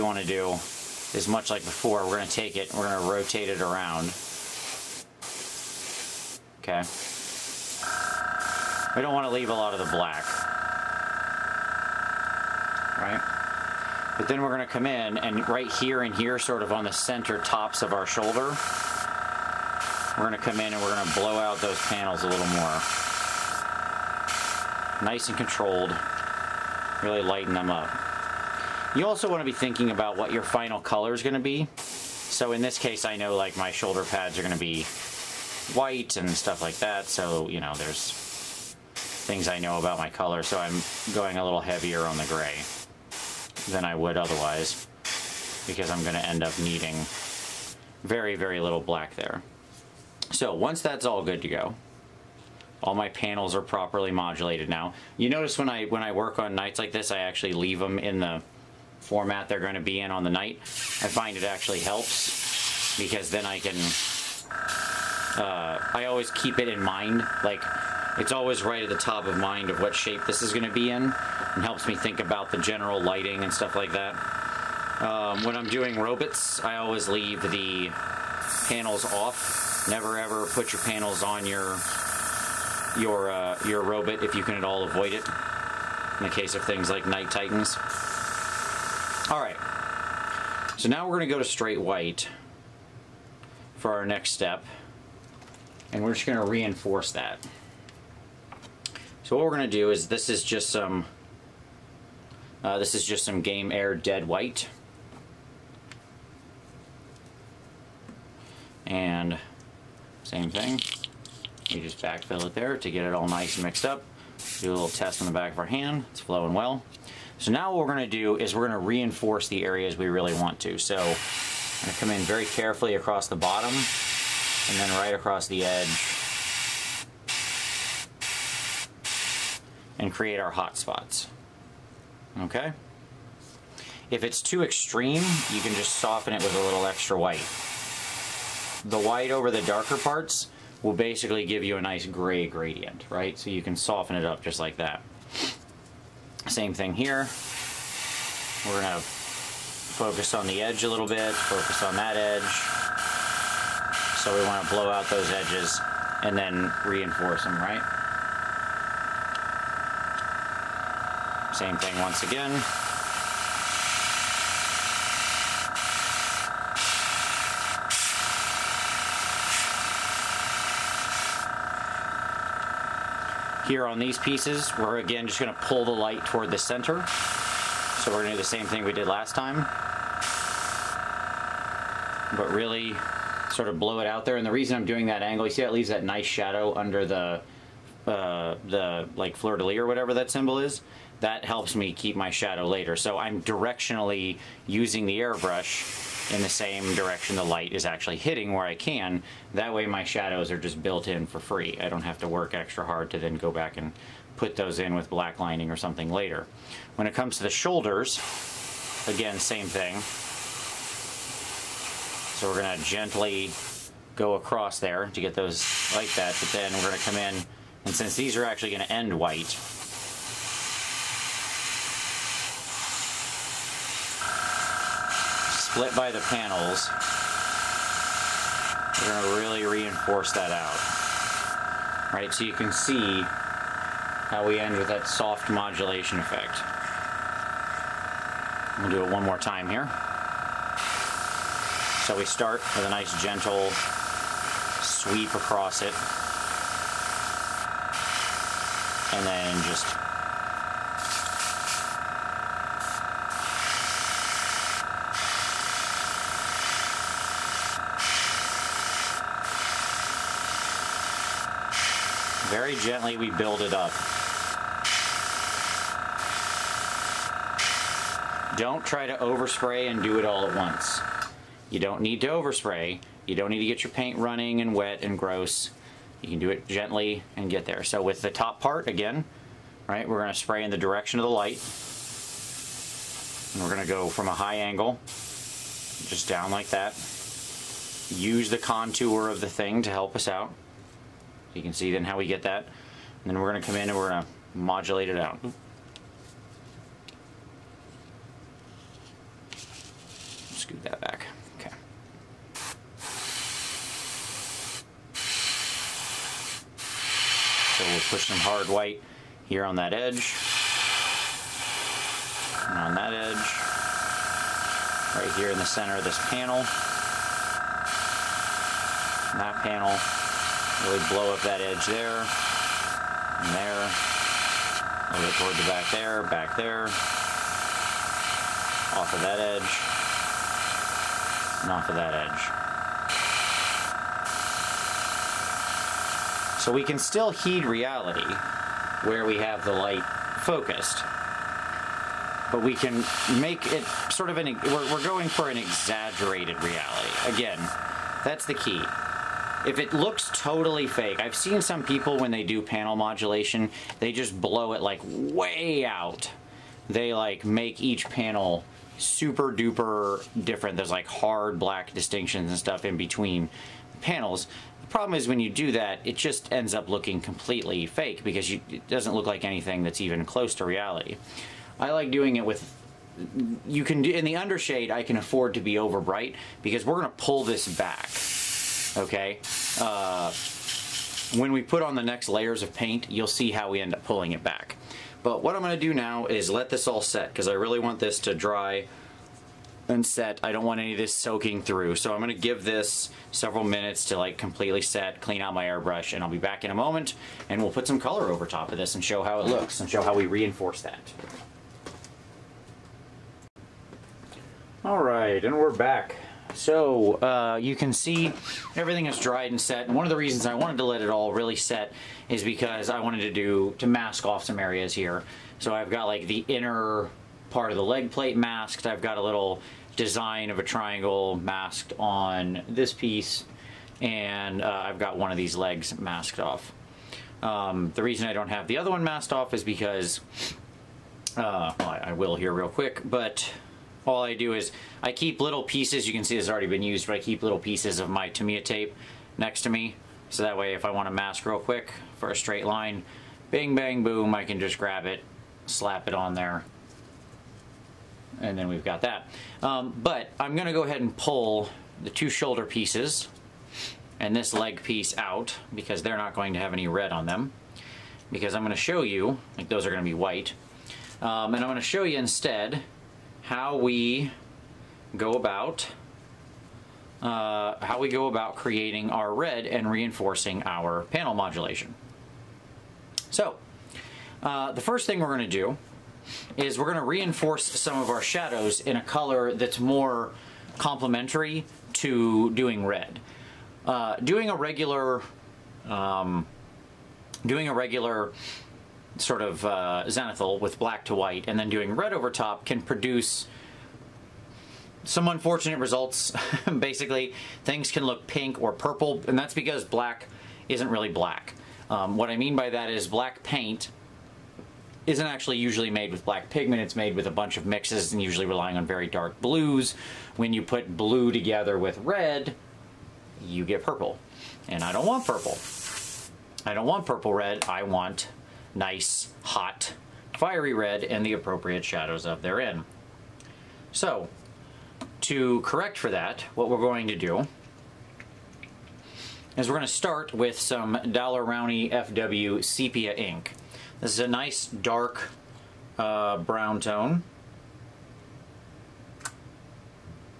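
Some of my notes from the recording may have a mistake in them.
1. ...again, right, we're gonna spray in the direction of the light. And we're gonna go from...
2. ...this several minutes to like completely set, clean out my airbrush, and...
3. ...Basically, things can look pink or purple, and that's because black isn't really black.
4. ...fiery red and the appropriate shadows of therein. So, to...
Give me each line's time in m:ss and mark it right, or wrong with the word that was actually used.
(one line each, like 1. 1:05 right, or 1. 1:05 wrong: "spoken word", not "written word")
1. 4:38 right
2. 6:32 right
3. 8:16 right
4. 8:40 right.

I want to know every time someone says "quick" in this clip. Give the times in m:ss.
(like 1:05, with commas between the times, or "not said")
7:12, 7:21.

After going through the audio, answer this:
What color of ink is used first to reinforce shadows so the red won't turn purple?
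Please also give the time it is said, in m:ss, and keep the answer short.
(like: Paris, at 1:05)
Sepia, at 8:52.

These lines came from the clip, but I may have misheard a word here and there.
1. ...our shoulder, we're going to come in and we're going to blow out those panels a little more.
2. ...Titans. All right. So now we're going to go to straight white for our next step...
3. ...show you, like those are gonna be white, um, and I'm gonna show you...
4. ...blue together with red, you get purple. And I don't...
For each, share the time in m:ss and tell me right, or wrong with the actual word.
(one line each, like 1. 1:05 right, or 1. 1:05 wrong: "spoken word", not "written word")
1. 0:17 right
2. 1:27 right
3. 7:38 right
4. 8:30 right.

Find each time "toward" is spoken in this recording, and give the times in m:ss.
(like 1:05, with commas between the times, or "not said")
2:56, 5:25.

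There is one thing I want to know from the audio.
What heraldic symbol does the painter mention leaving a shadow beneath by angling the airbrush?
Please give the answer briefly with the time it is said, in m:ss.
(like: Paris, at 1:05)
Fleur de lis, at 3:09.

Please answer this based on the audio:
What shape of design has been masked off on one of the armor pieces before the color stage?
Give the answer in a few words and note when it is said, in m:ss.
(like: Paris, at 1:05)
Triangle, at 7:00.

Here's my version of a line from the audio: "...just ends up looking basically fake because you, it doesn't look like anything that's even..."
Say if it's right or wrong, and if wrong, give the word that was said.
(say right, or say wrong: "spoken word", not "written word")
wrong: "completely", not "basically".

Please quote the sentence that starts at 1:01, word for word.
I find it actually helps because then I can, uh, I always keep it in mind.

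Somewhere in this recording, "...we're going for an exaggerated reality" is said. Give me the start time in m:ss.
5:44.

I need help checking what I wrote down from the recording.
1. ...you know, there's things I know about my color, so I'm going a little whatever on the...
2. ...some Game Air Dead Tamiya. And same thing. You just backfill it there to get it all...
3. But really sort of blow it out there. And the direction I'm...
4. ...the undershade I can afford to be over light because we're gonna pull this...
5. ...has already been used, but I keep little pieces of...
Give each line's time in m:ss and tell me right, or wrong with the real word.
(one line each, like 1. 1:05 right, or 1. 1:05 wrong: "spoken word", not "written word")
1. 0:37 wrong: "heavier", not "whatever"
2. 1:43 wrong: "White", not "Tamiya"
3. 3:02 wrong: "reason", not "direction"
4. 6:14 wrong: "bright", not "light"
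5. 7:16 right.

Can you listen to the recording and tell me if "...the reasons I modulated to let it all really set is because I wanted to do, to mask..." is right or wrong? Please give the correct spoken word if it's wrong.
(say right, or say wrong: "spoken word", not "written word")
wrong: "wanted", not "modulated".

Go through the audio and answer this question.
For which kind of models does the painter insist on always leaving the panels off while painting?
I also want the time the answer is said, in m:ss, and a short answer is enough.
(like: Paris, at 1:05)
Robots, at 1:15.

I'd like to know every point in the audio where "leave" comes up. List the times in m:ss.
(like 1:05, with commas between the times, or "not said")
0:09, 0:57, 1:17, 3:05.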